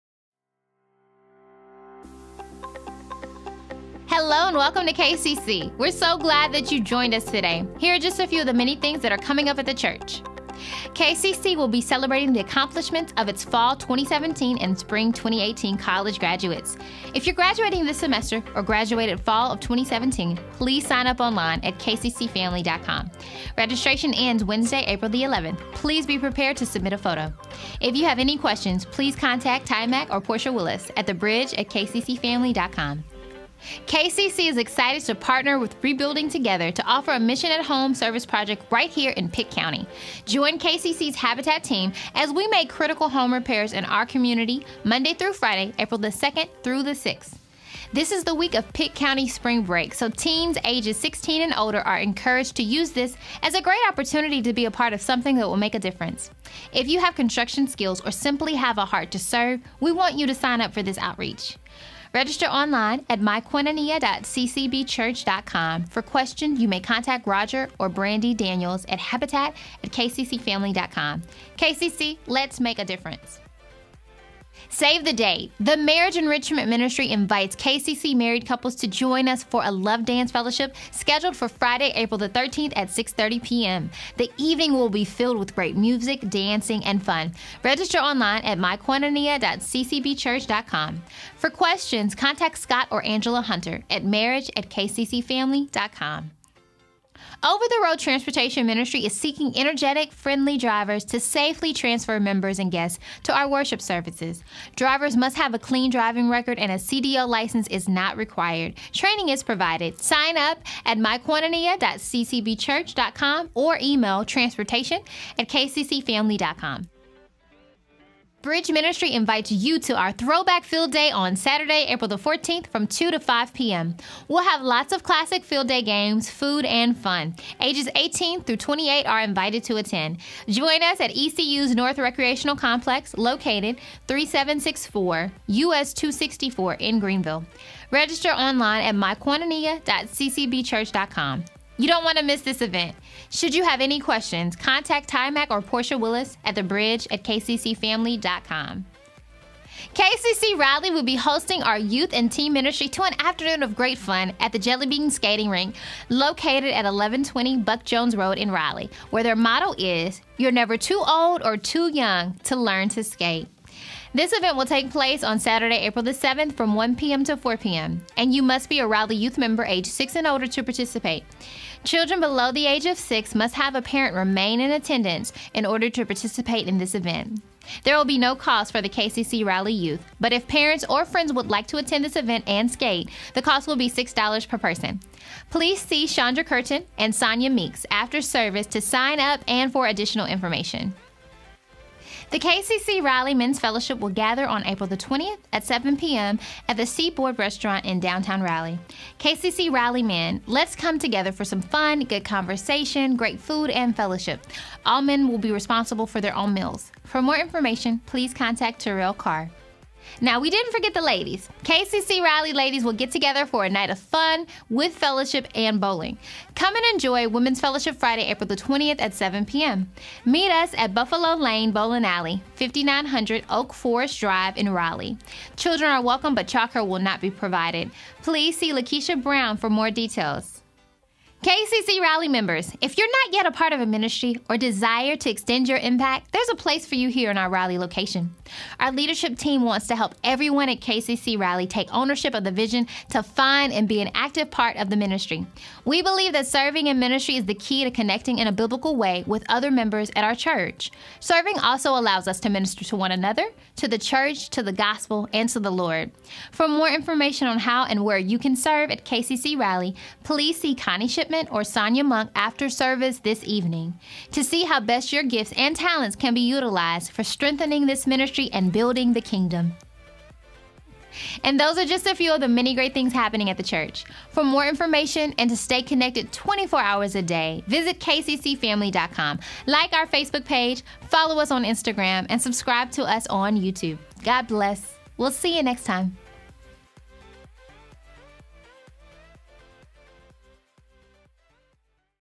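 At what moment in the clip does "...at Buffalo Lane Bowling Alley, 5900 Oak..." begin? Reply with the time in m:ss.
3:40.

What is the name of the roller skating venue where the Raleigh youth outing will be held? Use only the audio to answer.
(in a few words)
Jelly Bean Skating Rink.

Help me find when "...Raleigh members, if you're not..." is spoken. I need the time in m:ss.
3:51.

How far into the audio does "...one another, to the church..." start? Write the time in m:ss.
4:12.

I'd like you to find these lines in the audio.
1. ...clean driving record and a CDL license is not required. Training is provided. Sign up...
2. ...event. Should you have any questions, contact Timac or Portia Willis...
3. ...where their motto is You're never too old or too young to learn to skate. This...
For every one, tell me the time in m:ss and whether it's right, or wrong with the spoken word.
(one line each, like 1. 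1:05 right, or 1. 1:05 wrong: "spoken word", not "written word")
1. 1:45 right
2. 2:22 right
3. 2:39 right.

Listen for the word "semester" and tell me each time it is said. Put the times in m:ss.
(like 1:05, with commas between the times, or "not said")
0:17.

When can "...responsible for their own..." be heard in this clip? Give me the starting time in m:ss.
3:25.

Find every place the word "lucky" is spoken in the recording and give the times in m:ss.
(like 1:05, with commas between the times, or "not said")
not said.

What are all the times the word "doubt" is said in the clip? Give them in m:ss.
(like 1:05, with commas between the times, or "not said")
not said.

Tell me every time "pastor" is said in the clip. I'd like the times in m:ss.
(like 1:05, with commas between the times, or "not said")
not said.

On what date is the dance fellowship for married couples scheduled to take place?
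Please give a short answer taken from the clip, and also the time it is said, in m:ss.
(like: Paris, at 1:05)
April 13, at 1:21.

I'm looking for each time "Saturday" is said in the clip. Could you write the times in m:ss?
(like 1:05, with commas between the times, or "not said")
2:01, 2:45.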